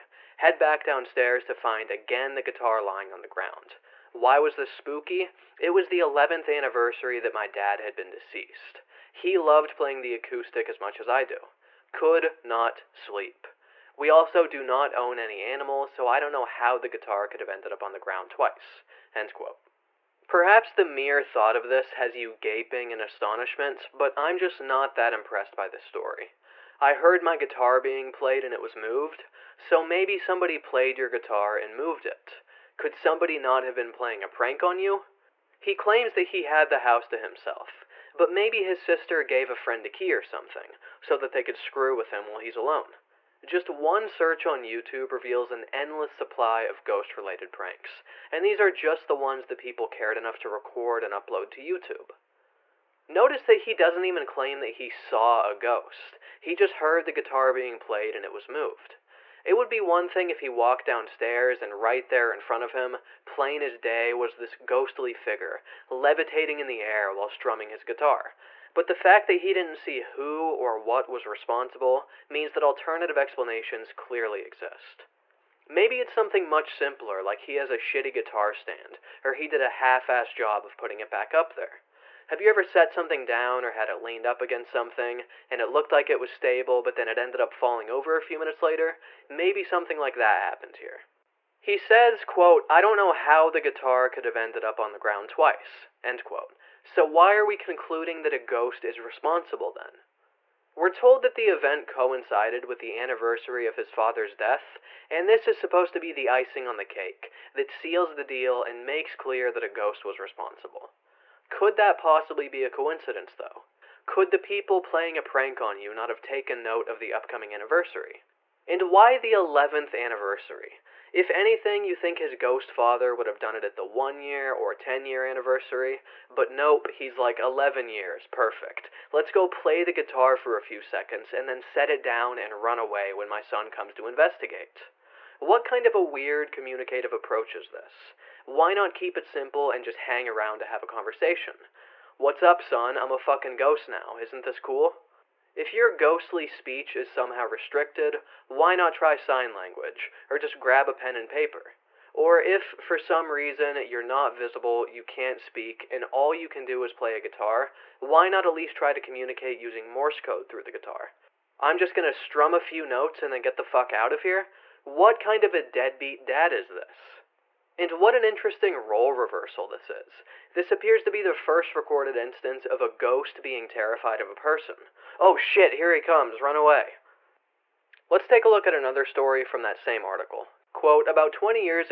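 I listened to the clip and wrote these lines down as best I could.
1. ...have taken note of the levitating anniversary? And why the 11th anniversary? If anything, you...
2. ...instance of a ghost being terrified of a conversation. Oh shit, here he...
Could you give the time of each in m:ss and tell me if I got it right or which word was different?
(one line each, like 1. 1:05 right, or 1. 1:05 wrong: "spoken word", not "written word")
1. 1:56 wrong: "upcoming", not "levitating"
2. 2:52 wrong: "person", not "conversation".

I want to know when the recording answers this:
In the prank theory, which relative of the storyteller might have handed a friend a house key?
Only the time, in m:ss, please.
0:38.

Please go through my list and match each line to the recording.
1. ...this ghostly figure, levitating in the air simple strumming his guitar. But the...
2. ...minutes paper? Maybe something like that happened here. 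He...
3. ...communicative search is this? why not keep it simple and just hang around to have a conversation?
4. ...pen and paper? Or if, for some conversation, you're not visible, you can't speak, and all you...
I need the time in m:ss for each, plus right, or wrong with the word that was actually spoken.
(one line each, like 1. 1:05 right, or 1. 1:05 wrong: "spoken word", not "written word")
1. 1:04 wrong: "while", not "simple"
2. 1:28 wrong: "later", not "paper"
3. 2:16 wrong: "approach", not "search"
4. 2:30 wrong: "reason", not "conversation".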